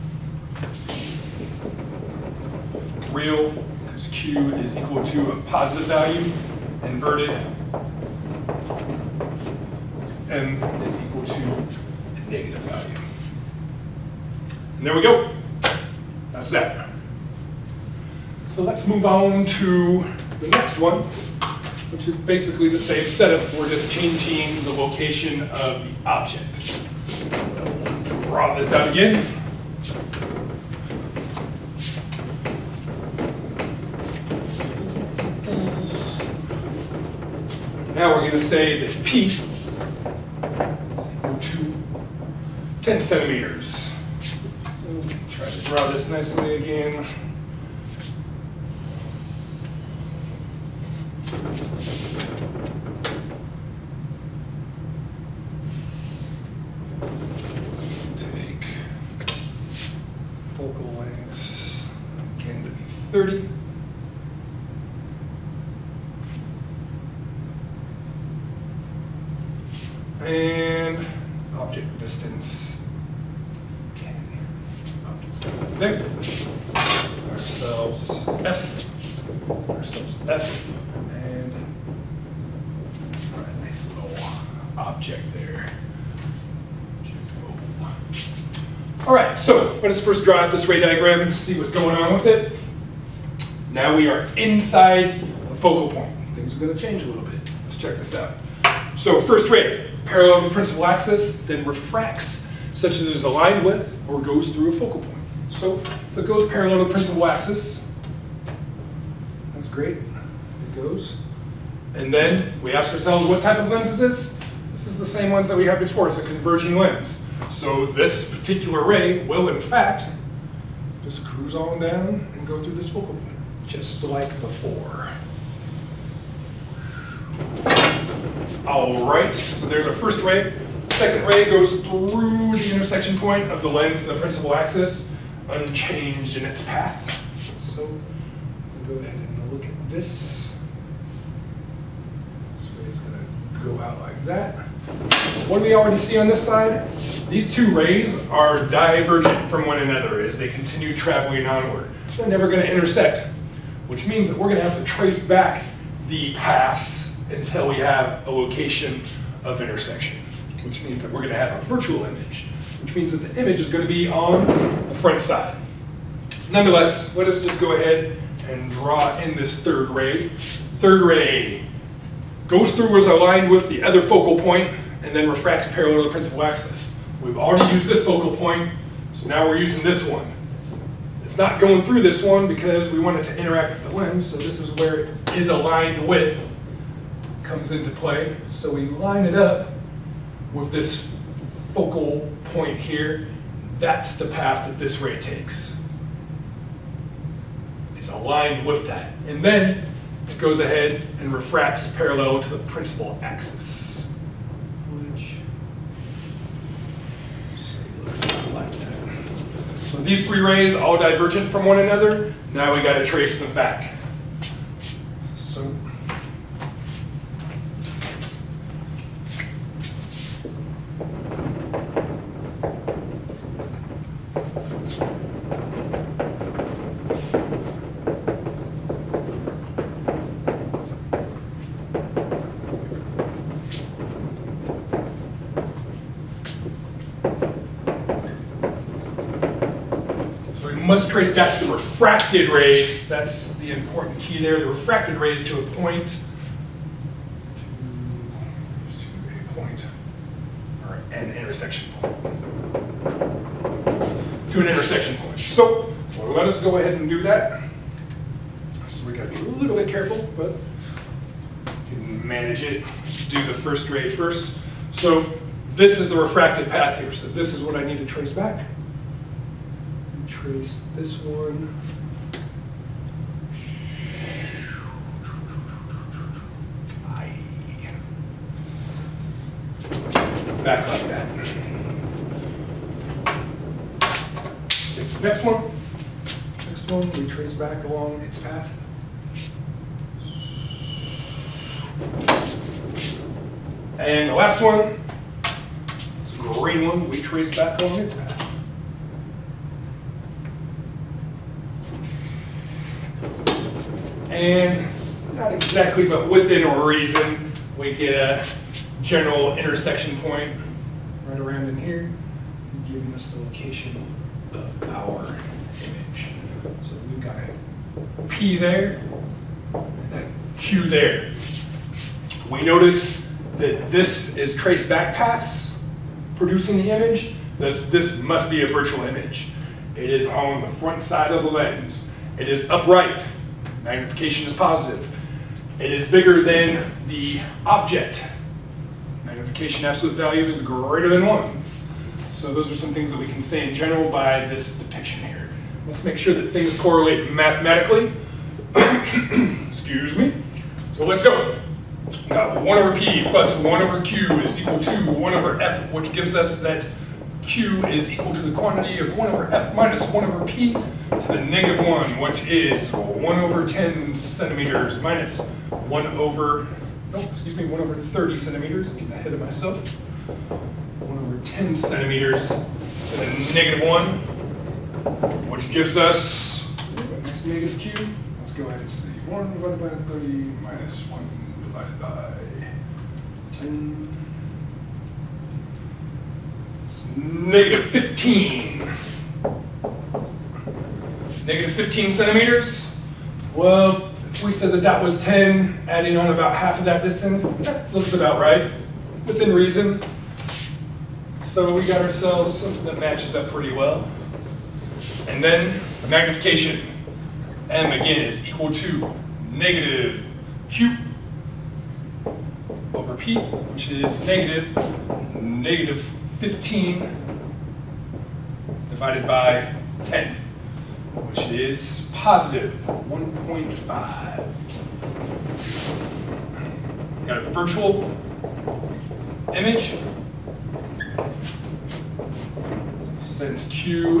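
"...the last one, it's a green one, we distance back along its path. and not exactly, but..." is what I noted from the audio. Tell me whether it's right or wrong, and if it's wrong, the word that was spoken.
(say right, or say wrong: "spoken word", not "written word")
wrong: "trace", not "distance".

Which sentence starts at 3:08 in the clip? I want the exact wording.
So we line it up with this focal point here, that's the path that this ray takes.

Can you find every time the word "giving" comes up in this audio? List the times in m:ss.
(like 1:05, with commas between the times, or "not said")
5:12.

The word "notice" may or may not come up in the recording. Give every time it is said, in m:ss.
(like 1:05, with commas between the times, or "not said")
5:22.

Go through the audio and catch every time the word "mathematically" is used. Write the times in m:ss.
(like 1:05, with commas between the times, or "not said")
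5:47.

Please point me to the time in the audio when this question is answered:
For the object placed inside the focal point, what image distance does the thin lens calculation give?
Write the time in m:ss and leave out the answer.
6:31.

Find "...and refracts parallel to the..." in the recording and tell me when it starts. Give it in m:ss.
3:21.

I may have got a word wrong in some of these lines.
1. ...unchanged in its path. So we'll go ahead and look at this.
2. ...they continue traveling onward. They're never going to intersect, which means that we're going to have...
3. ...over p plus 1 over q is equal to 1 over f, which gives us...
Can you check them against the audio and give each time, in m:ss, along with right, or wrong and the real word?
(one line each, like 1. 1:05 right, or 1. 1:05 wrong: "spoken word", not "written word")
1. 2:15 right
2. 2:30 right
3. 5:52 right.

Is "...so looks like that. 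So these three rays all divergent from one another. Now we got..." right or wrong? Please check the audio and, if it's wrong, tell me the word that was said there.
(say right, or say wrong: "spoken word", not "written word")
right.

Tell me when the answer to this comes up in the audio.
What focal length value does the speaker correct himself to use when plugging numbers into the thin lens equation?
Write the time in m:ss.
6:07.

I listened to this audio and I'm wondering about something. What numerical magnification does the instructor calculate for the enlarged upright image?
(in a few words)
1.5.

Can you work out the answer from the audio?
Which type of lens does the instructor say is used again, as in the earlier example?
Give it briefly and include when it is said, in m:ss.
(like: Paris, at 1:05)
converging lens, at 1:56.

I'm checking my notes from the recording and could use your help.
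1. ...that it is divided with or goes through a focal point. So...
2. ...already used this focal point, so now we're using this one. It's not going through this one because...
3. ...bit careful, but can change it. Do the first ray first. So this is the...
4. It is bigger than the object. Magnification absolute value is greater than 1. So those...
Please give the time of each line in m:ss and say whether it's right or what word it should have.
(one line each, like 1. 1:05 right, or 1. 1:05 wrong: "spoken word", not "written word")
1. 1:42 wrong: "aligned", not "divided"
2. 2:57 right
3. 4:19 wrong: "manage", not "change"
4. 5:35 right.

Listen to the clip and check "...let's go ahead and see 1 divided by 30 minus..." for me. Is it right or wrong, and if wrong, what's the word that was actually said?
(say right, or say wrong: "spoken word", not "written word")
right.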